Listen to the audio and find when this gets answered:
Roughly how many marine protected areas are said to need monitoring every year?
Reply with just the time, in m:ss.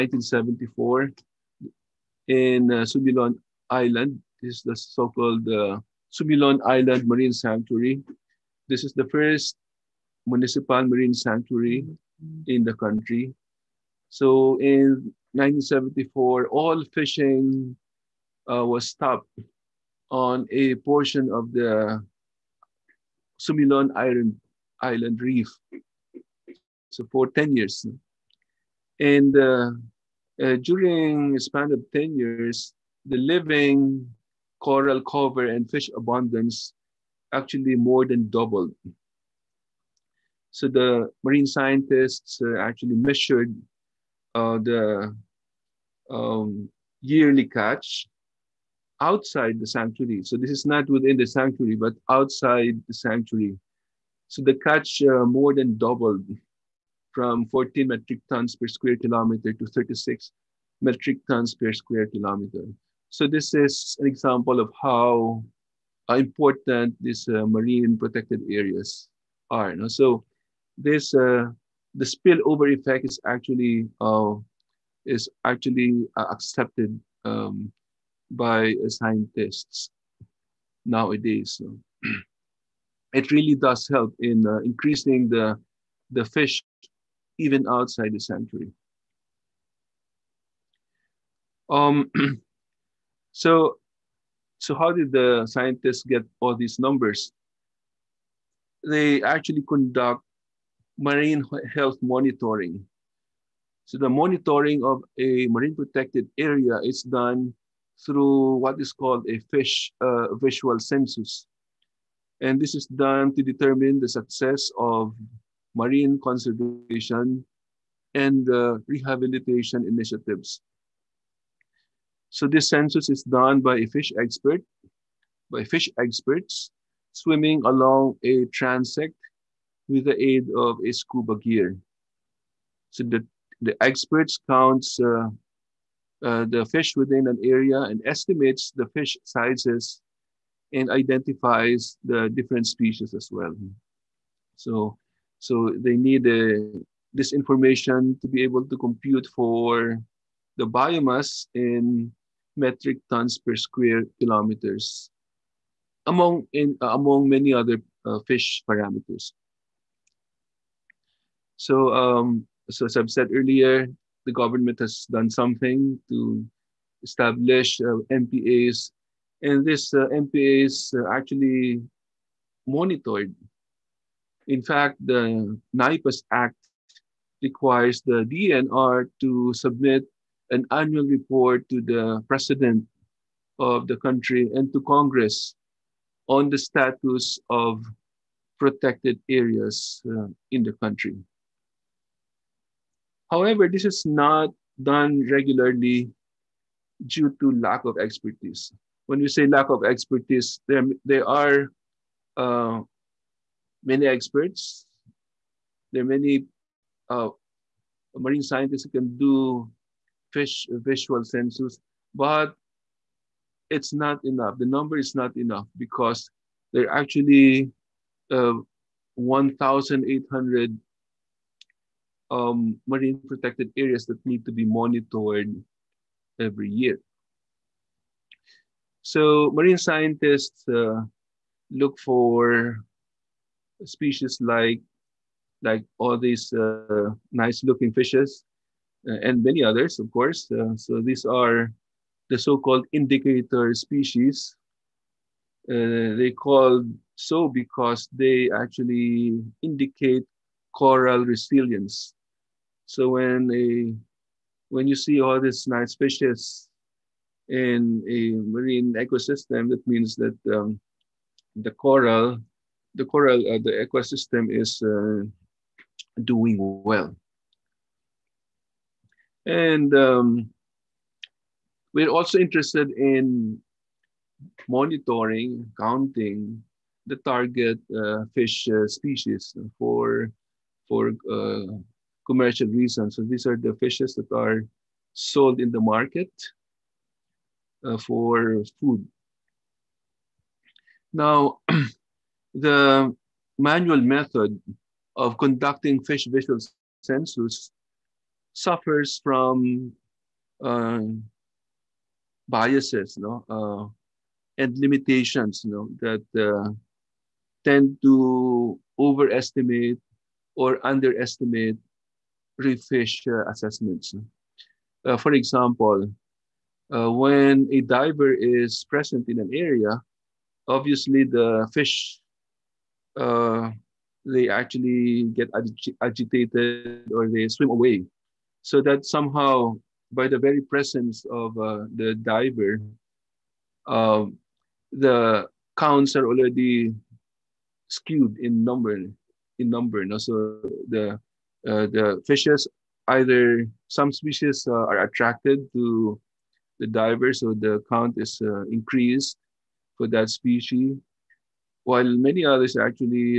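3:39.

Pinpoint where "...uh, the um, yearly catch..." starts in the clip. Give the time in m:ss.
0:44.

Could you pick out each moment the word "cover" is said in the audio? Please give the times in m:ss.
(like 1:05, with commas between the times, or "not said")
0:35.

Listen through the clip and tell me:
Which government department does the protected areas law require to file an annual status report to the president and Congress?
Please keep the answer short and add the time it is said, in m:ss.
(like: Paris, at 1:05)
DNR, at 2:58.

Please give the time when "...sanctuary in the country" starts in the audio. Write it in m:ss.
0:11.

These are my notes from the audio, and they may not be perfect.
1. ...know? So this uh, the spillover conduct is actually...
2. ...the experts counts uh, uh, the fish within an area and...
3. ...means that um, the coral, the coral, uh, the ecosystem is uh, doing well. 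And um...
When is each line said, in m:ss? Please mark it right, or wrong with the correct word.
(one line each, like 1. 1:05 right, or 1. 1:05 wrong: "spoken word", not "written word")
1. 1:09 wrong: "effect", not "conduct"
2. 2:13 right
3. 4:19 right.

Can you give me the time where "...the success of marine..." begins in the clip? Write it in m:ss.
1:53.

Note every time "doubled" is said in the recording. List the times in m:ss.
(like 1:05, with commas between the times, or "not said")
0:38, 0:55.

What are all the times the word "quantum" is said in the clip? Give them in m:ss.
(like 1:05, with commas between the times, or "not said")
not said.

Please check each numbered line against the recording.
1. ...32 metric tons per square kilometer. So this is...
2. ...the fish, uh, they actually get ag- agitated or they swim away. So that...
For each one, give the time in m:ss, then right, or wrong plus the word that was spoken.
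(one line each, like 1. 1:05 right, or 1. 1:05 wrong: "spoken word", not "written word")
1. 0:59 wrong: "36", not "32"
2. 5:21 right.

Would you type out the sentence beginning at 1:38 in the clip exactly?
They actually conduct marine health monitoring.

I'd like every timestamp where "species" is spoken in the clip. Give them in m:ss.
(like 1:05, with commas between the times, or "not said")
2:22, 3:53, 4:03, 4:38, 5:44, 5:50.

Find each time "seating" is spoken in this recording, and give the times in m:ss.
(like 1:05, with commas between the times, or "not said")
not said.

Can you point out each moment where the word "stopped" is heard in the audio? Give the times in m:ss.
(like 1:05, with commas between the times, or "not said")
0:18.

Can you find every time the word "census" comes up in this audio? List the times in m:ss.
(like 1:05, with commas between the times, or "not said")
1:50, 2:02, 3:31, 4:57.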